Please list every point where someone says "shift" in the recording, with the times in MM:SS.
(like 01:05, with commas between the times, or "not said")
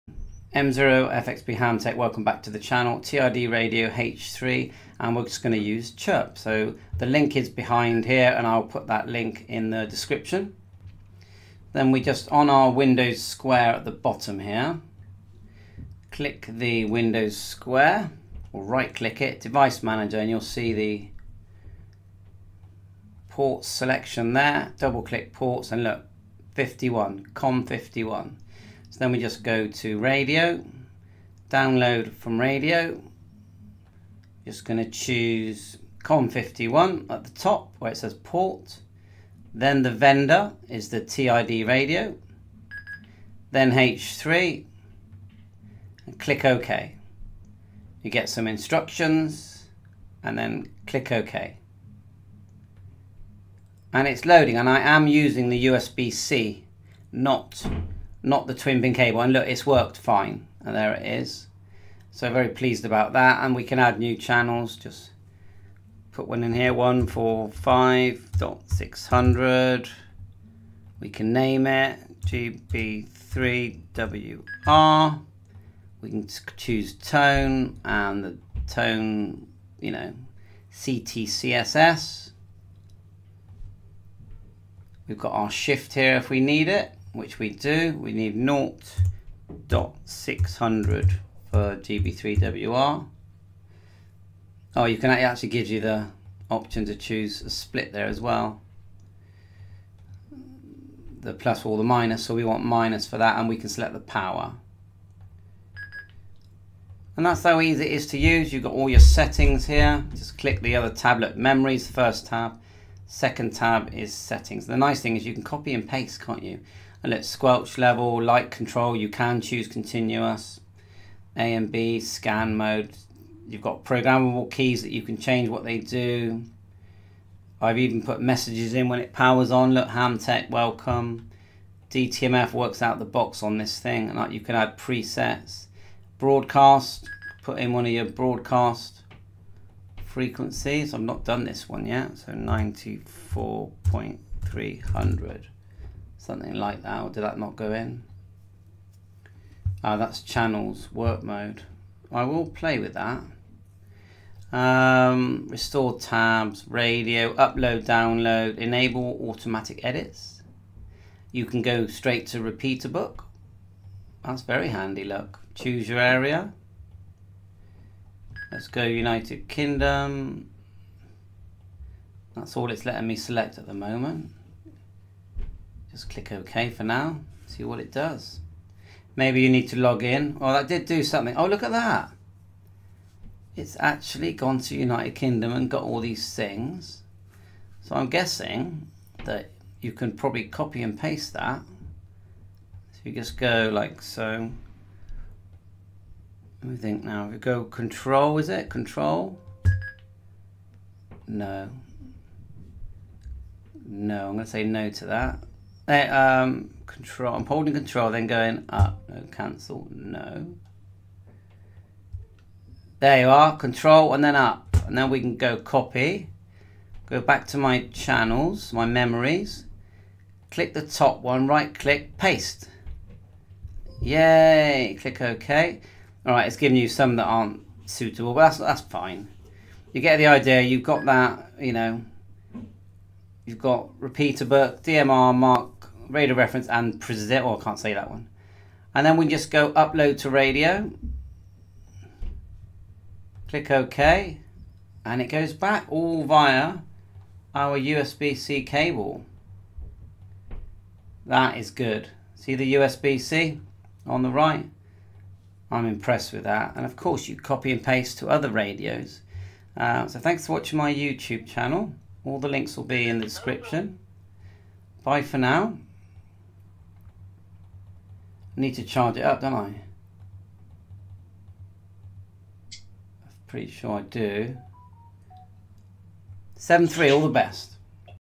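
01:25.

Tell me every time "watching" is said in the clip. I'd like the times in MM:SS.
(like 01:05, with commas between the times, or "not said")
04:20.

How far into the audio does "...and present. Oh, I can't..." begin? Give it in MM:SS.
03:56.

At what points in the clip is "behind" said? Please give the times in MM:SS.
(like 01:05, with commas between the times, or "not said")
00:07.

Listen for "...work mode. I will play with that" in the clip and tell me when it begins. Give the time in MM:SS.
02:30.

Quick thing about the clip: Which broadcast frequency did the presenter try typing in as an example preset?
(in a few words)
94.300.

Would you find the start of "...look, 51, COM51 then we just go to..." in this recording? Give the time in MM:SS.
00:25.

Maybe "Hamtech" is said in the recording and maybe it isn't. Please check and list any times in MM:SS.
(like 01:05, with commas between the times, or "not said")
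00:01, 02:09.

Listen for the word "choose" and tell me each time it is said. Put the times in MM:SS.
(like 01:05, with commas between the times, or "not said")
00:34, 01:16, 01:36, 01:59, 02:45.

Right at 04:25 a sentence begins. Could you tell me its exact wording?
Bye for now need to charge it up, don't I?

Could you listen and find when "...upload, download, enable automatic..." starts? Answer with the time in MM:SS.
02:37.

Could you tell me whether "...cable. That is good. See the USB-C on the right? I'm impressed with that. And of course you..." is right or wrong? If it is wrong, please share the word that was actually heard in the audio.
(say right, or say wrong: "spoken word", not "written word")
right.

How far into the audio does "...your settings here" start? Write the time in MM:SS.
01:48.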